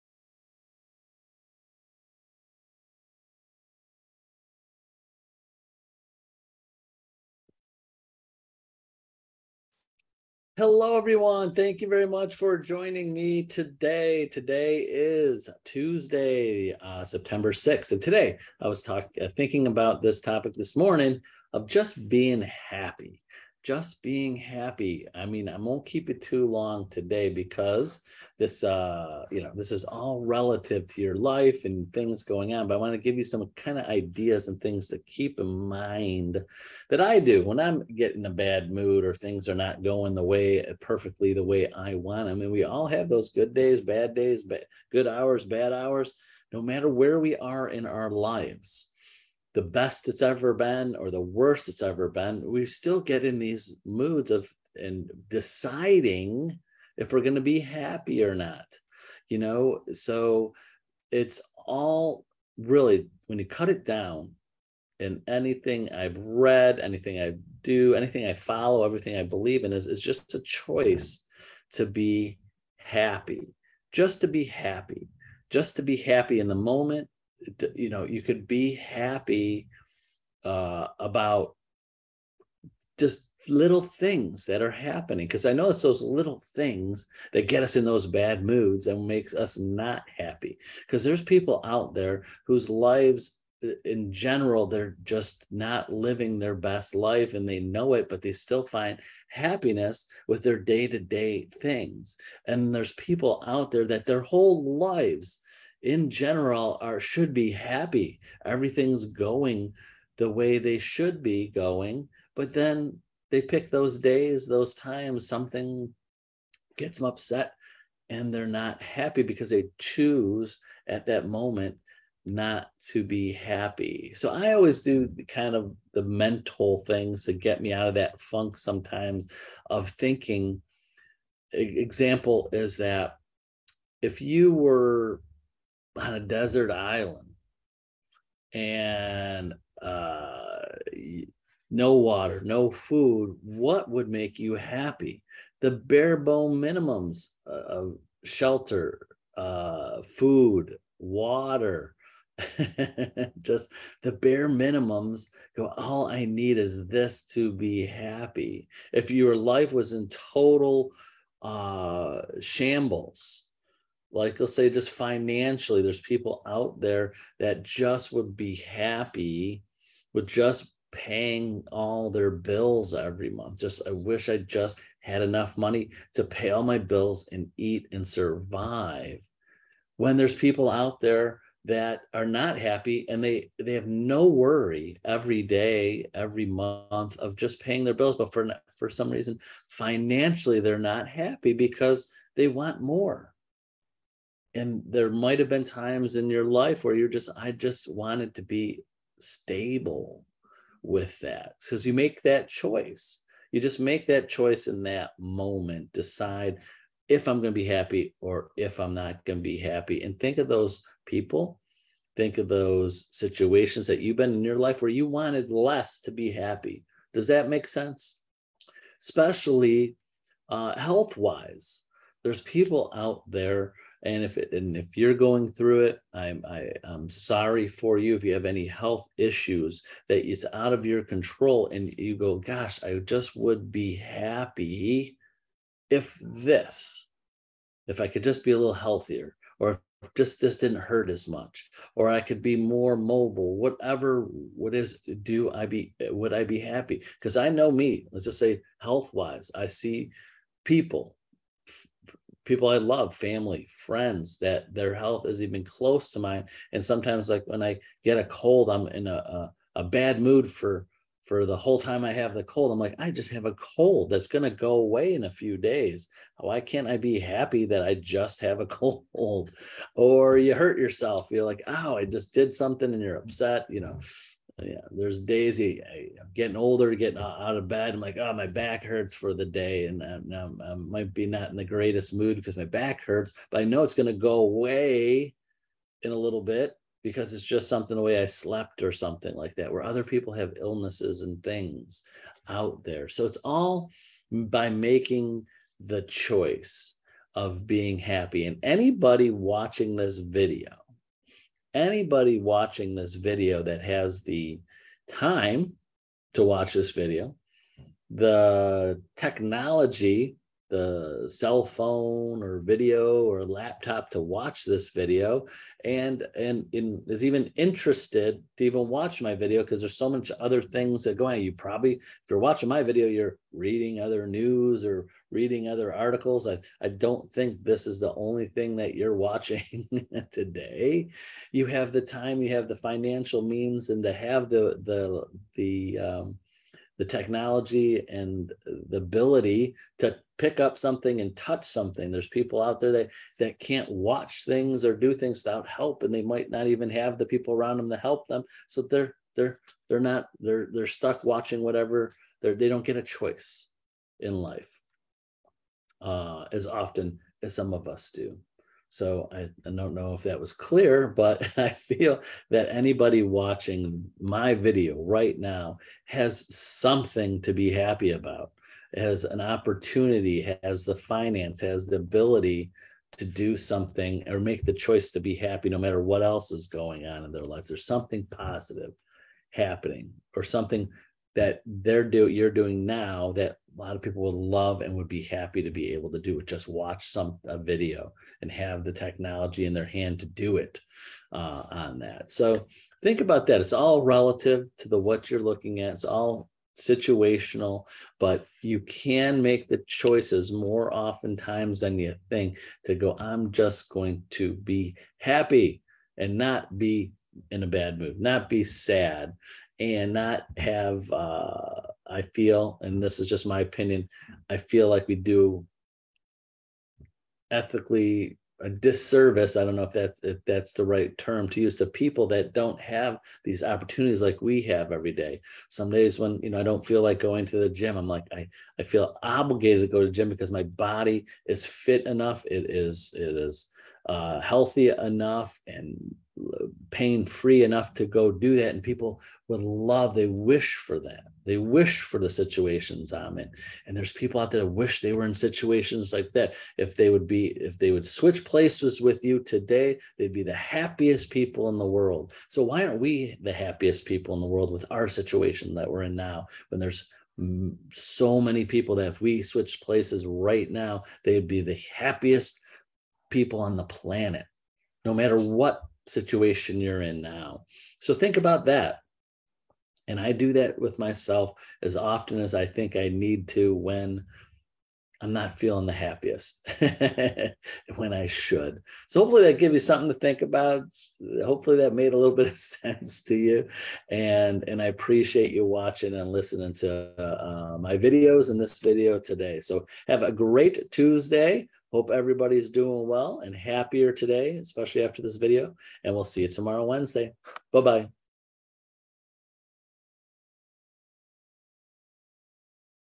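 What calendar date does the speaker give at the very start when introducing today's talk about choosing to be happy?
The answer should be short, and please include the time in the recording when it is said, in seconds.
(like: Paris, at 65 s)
September 6th, at 17 s.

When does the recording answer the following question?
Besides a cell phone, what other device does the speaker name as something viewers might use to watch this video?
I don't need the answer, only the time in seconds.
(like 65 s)
313 s.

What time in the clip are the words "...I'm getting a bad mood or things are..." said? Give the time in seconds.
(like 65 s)
37 s.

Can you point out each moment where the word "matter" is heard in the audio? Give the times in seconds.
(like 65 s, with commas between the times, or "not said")
46 s, 375 s, 465 s.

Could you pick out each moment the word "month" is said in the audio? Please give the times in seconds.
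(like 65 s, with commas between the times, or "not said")
173 s, 186 s.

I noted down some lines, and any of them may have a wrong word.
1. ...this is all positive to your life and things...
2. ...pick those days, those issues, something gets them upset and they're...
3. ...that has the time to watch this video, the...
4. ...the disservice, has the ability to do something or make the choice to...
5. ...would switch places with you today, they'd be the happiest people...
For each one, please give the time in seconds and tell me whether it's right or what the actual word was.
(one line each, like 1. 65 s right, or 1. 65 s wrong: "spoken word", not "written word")
1. 29 s wrong: "relative", not "positive"
2. 113 s wrong: "times", not "issues"
3. 303 s right
4. 370 s wrong: "finance", not "disservice"
5. 447 s right.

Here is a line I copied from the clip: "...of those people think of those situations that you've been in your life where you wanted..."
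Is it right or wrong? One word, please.
right.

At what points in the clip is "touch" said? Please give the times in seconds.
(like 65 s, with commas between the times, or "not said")
341 s.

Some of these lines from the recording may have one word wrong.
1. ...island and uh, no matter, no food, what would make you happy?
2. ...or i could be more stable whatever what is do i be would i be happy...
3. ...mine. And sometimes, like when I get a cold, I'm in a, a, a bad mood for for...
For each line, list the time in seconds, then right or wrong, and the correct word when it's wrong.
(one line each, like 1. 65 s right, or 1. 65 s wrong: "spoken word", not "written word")
1. 136 s wrong: "water", not "matter"
2. 241 s wrong: "mobile", not "stable"
3. 256 s right.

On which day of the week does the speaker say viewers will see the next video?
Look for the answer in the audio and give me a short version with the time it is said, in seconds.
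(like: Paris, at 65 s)
Wednesday, at 496 s.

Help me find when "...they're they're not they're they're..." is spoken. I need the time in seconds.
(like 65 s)
349 s.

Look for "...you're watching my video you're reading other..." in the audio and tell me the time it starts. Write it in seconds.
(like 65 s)
322 s.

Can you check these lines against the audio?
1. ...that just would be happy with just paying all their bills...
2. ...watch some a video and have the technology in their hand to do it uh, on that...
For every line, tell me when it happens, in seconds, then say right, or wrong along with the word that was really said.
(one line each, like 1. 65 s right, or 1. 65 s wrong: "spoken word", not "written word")
1. 167 s right
2. 386 s right.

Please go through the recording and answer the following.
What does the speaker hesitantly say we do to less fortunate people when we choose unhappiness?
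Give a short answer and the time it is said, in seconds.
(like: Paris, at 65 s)
A disservice, at 418 s.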